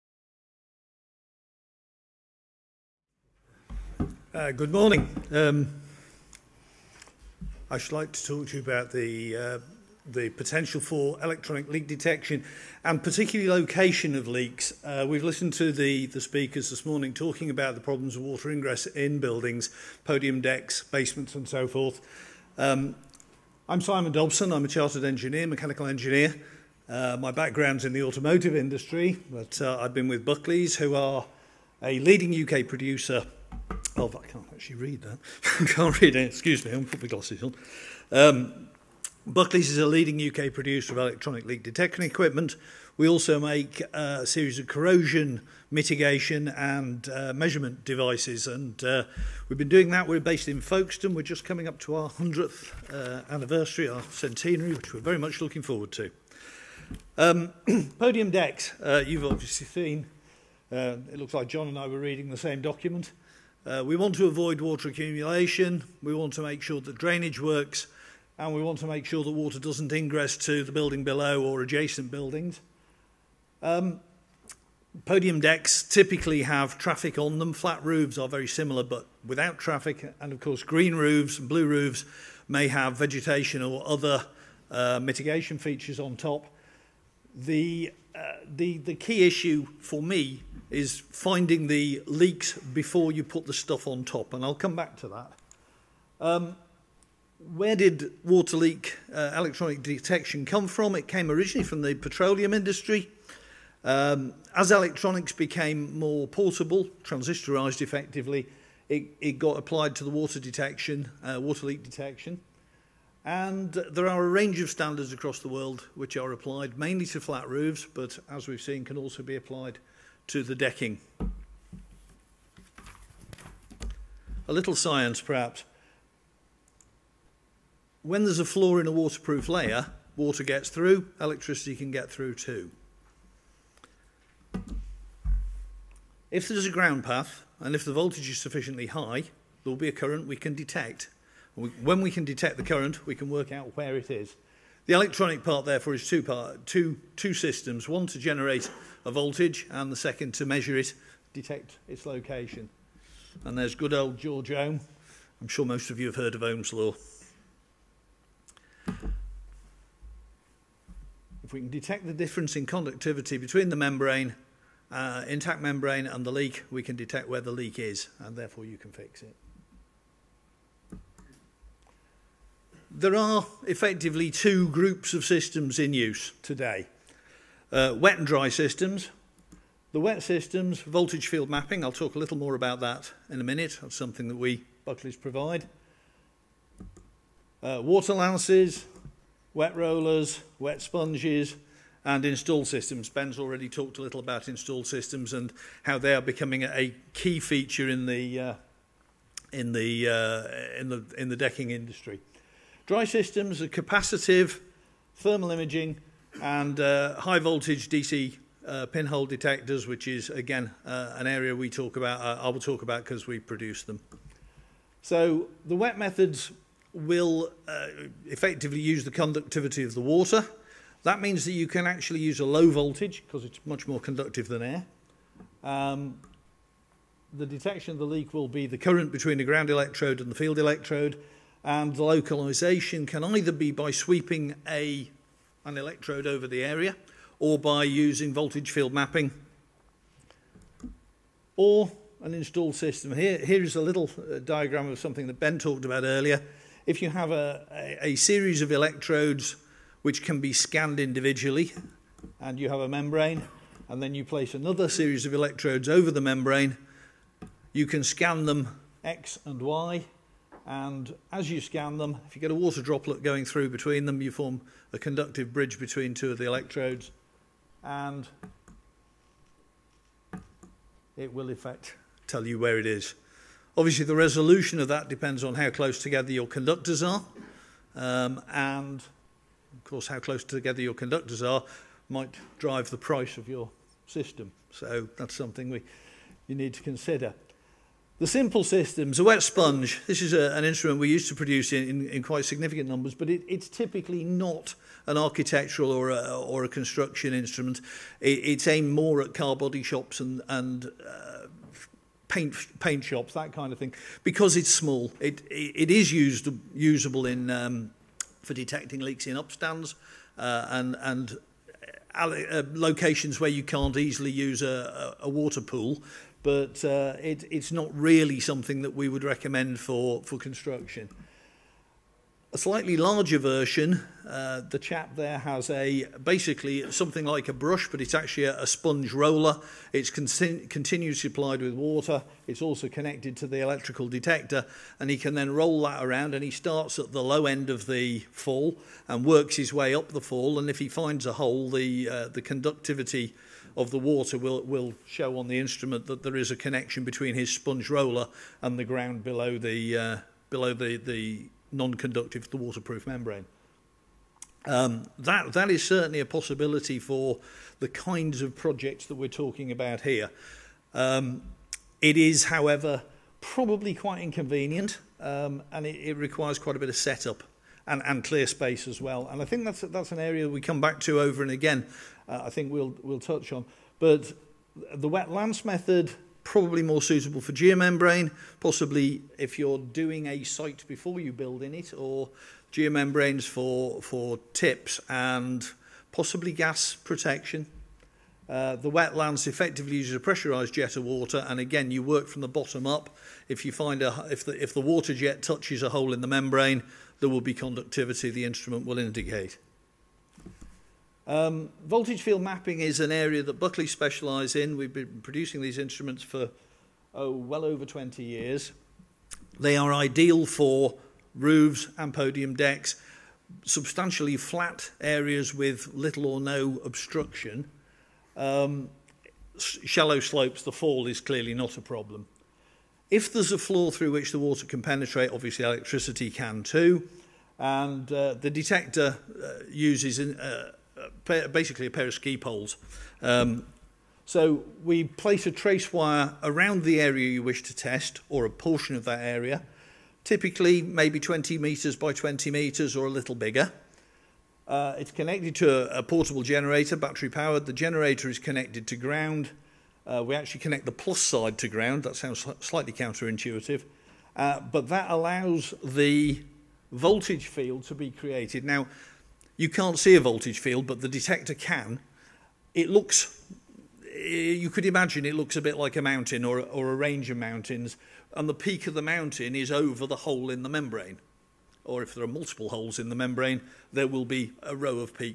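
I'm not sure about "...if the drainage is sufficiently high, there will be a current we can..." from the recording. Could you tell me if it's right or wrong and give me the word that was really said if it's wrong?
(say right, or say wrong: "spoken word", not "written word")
wrong: "voltage", not "drainage".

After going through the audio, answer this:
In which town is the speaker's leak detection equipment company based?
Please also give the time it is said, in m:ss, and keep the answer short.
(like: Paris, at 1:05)
Folkestone, at 0:50.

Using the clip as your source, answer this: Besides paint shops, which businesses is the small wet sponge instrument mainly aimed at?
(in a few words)
car body shops.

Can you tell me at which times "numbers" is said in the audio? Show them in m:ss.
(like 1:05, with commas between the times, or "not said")
4:52.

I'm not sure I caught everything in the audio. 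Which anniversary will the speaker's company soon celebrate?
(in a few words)
100th anniversary.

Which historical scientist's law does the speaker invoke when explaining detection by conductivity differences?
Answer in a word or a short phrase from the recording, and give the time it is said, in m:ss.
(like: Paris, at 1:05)
George Ohm, at 2:34.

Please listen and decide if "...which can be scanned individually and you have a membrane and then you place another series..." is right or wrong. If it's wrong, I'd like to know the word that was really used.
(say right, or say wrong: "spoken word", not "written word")
right.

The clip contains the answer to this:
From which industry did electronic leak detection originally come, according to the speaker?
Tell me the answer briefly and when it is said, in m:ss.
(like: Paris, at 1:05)
petroleum industry, at 1:41.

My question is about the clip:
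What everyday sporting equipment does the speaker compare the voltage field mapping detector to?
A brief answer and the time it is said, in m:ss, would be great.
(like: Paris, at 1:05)
ski poles, at 7:12.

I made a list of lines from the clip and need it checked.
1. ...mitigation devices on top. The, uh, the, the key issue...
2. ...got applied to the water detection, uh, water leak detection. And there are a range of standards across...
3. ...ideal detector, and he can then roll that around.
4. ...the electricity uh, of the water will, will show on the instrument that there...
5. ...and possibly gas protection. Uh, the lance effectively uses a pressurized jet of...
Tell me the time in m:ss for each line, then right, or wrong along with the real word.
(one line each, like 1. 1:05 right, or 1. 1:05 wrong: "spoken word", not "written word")
1. 1:25 wrong: "features", not "devices"
2. 1:49 right
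3. 5:33 wrong: "electrical", not "ideal"
4. 5:42 wrong: "conductivity", not "electricity"
5. 6:25 right.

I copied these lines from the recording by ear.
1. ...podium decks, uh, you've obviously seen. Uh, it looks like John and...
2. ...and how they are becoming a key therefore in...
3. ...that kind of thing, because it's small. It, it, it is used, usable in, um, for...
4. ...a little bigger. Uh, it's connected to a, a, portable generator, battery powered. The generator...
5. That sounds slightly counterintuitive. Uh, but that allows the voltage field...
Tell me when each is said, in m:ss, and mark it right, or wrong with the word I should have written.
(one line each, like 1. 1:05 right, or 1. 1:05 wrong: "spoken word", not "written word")
1. 0:57 right
2. 3:15 wrong: "feature", not "therefore"
3. 5:03 right
4. 7:23 right
5. 7:32 right.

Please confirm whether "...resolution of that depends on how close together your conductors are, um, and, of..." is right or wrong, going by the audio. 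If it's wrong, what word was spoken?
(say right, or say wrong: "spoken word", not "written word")
right.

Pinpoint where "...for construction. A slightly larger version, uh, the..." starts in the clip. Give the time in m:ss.
5:20.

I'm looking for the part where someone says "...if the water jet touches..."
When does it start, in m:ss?
6:34.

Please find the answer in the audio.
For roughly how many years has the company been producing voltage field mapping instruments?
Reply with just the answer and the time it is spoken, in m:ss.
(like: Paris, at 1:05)
over 20 years, at 6:47.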